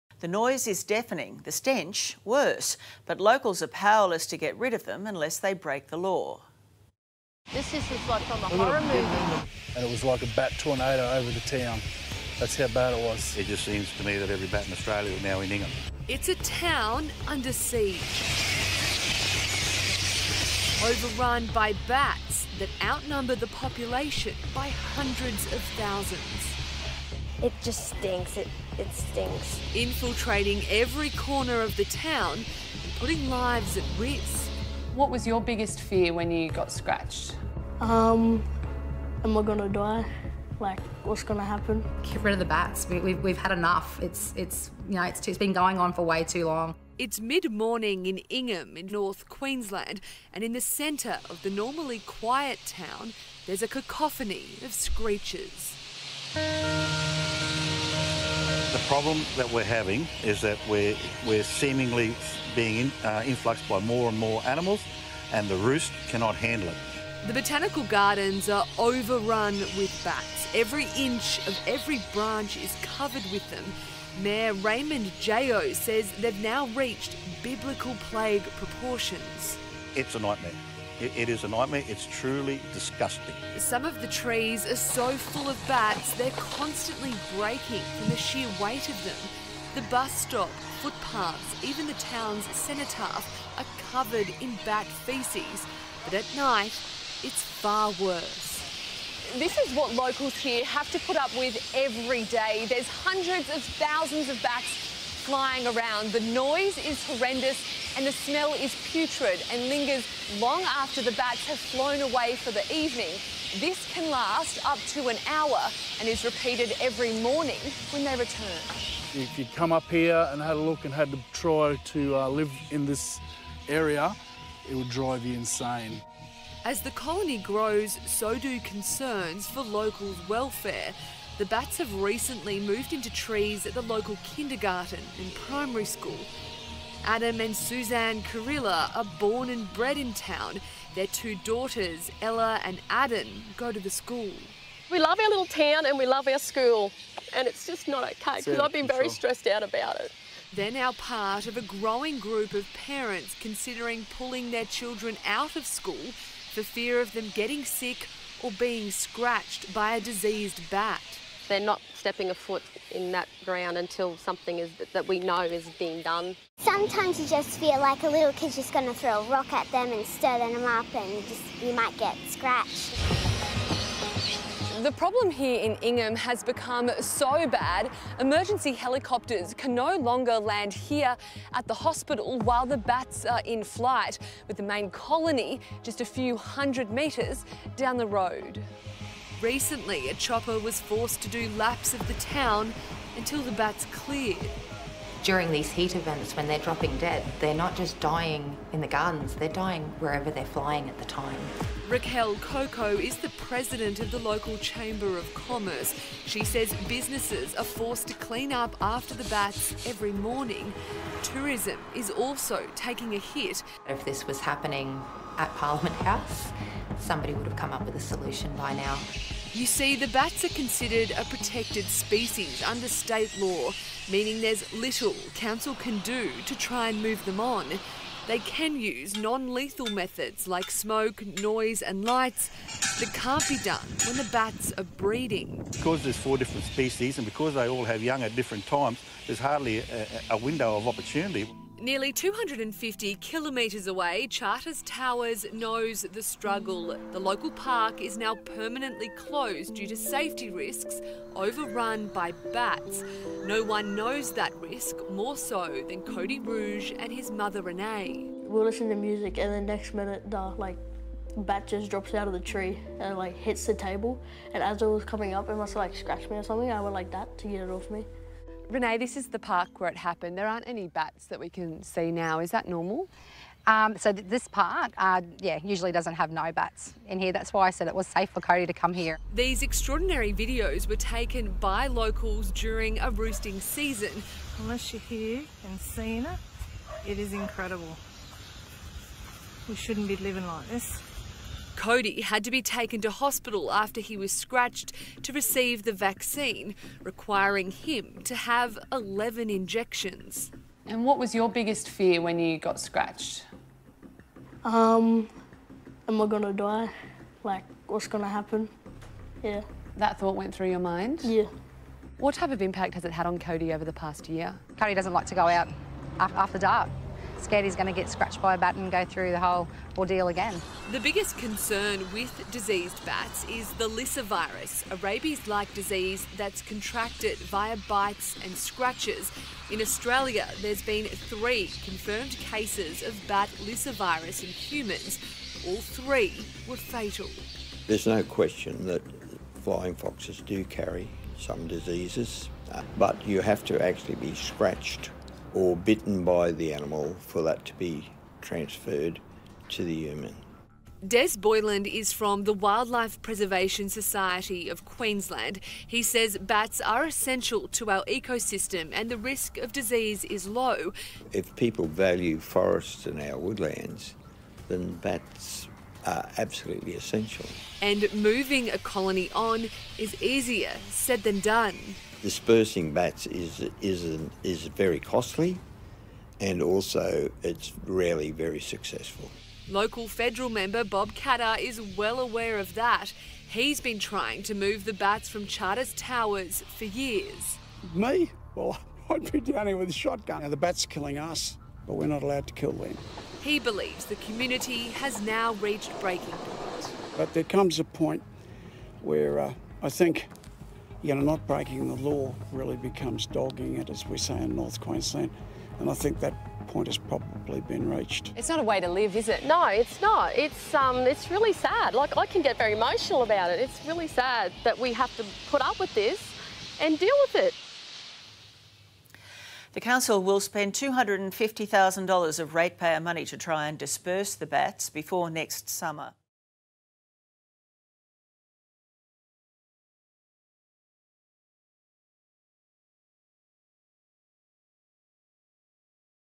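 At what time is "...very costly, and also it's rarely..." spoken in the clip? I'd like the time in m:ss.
6:14.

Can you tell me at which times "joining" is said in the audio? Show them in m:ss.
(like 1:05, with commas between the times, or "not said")
not said.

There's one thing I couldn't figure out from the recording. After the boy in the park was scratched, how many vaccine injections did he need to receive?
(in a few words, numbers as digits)
11.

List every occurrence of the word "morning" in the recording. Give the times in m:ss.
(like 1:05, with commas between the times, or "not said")
0:47, 1:57, 3:30.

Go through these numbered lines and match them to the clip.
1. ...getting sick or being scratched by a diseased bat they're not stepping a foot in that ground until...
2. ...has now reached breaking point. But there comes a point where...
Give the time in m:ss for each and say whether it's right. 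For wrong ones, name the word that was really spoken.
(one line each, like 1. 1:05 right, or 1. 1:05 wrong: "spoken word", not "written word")
1. 2:37 right
2. 6:34 right.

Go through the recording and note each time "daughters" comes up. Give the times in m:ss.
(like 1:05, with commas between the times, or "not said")
2:21.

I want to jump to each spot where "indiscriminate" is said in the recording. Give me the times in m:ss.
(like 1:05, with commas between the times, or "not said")
not said.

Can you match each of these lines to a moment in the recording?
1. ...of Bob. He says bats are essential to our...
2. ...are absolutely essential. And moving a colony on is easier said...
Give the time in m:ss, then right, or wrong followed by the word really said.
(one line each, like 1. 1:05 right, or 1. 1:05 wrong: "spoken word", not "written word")
1. 5:54 wrong: "Queensland", not "Bob"
2. 6:06 right.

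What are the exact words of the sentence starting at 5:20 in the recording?
The biggest concern with diseased bats is the lyssa virus, a rabies like disease that's contracted via bites and scratches.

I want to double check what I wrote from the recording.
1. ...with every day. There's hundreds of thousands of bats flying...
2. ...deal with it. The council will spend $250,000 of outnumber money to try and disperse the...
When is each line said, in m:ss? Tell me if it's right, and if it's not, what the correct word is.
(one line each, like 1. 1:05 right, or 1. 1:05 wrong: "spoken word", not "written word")
1. 1:41 right
2. 6:56 wrong: "ratepayer", not "outnumber".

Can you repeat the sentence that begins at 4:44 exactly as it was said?
Unless you're here and seeing it, it is incredible.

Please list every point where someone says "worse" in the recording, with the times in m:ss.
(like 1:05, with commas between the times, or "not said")
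0:02, 1:37.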